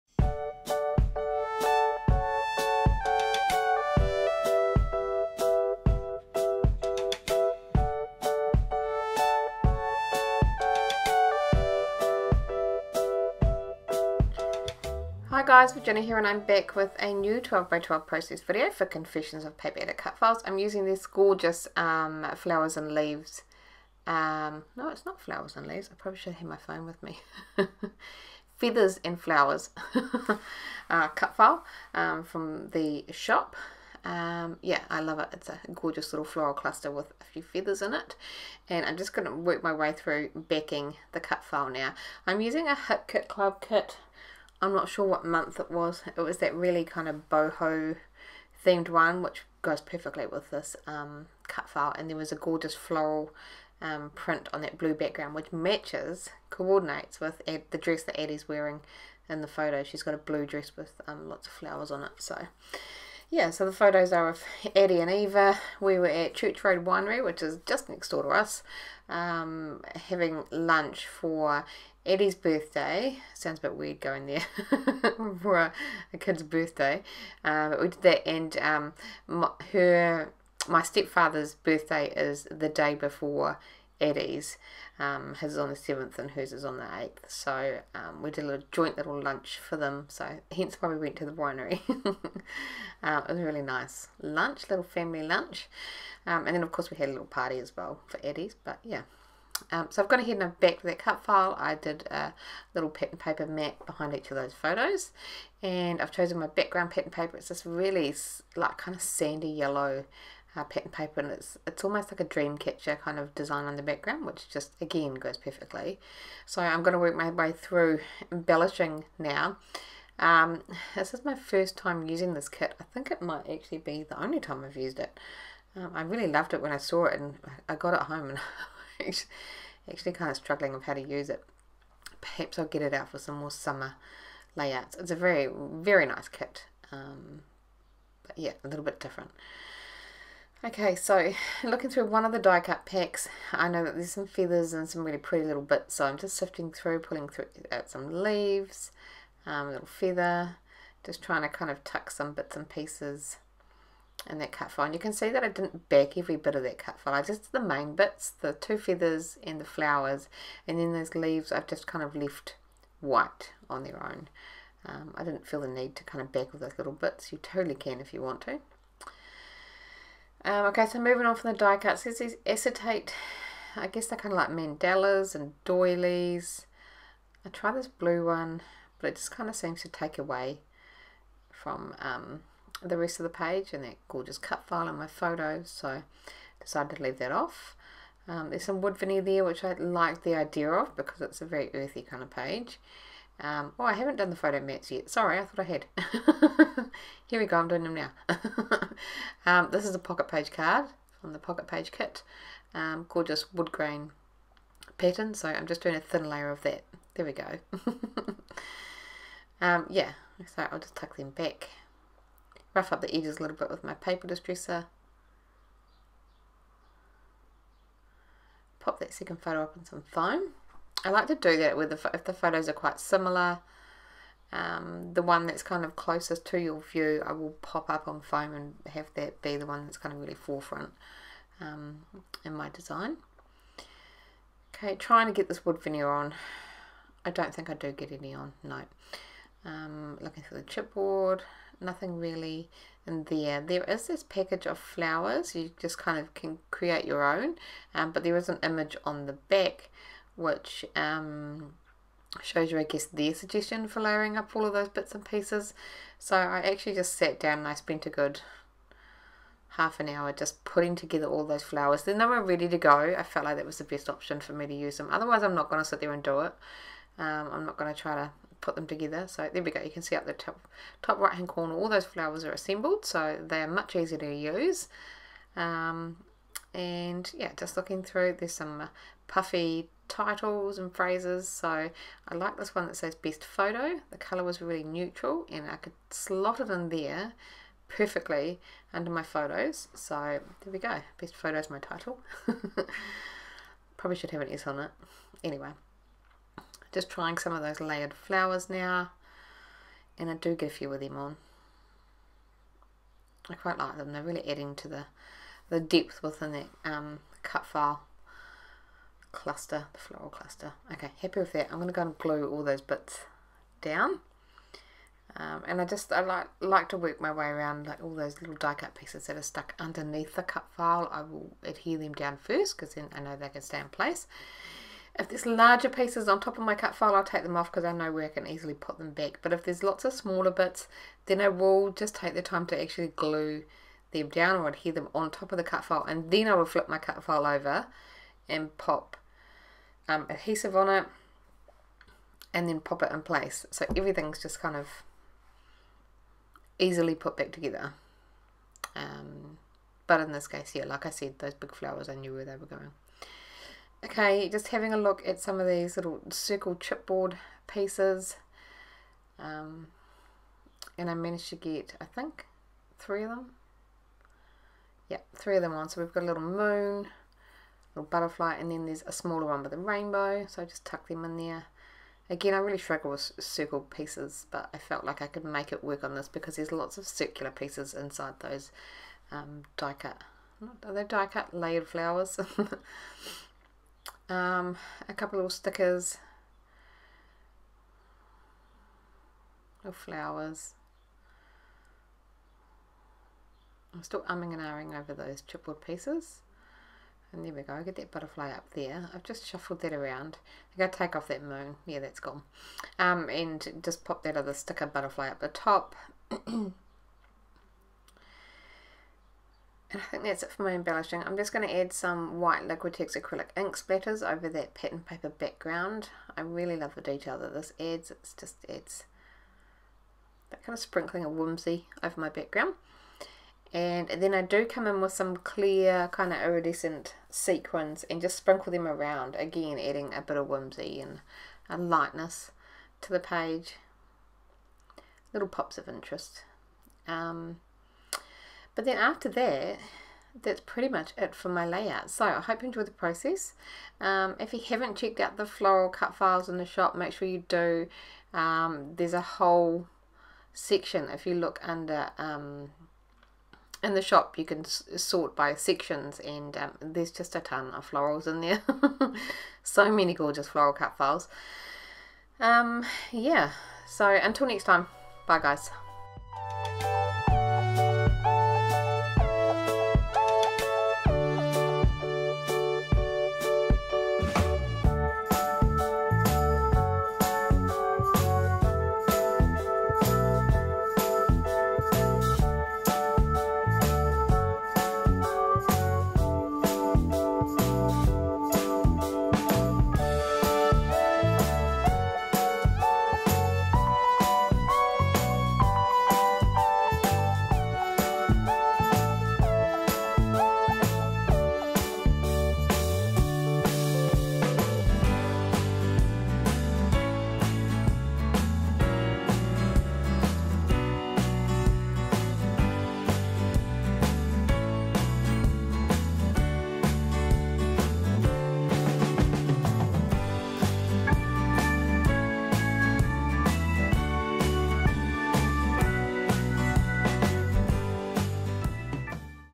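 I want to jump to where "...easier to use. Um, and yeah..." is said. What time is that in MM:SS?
04:33.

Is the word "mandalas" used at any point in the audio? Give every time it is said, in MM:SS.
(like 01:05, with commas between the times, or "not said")
02:54.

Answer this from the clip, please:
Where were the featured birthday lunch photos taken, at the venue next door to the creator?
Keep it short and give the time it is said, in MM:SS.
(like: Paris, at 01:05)
Church Road Winery, at 01:06.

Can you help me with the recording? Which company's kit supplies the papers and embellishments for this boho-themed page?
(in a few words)
Hip Kit Club.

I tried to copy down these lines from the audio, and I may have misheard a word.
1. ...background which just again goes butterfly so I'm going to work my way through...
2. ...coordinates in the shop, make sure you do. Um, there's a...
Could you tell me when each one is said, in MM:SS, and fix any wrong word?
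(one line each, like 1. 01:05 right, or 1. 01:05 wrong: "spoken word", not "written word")
1. 01:53 wrong: "perfectly", not "butterfly"
2. 07:26 wrong: "files", not "coordinates".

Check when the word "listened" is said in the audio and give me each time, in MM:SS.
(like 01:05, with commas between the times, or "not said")
not said.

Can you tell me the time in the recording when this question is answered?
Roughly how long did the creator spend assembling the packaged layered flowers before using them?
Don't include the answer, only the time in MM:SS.
04:19.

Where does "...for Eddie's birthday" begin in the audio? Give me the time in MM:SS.
01:11.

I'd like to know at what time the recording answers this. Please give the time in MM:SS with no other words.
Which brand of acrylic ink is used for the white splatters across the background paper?
06:52.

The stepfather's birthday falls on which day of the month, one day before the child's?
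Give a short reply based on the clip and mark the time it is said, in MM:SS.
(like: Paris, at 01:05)
7th, at 01:25.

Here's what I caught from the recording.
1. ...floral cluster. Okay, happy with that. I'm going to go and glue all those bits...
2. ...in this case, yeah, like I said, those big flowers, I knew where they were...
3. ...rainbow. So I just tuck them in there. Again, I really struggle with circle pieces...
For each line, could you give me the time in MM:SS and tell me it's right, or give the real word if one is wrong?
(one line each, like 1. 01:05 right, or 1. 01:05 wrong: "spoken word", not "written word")
1. 05:09 right
2. 05:50 right
3. 06:09 right.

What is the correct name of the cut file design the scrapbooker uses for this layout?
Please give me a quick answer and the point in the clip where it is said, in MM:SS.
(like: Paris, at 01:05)
Feathers and flowers, at 00:28.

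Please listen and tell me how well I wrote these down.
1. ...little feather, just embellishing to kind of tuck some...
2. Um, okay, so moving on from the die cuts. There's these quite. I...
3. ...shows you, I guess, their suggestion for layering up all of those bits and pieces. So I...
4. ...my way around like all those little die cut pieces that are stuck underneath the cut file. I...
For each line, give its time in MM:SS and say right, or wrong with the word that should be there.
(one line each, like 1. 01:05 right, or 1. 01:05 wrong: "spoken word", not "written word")
1. 02:29 wrong: "trying", not "embellishing"
2. 02:50 wrong: "acetate", not "quite"
3. 04:12 right
4. 05:17 right.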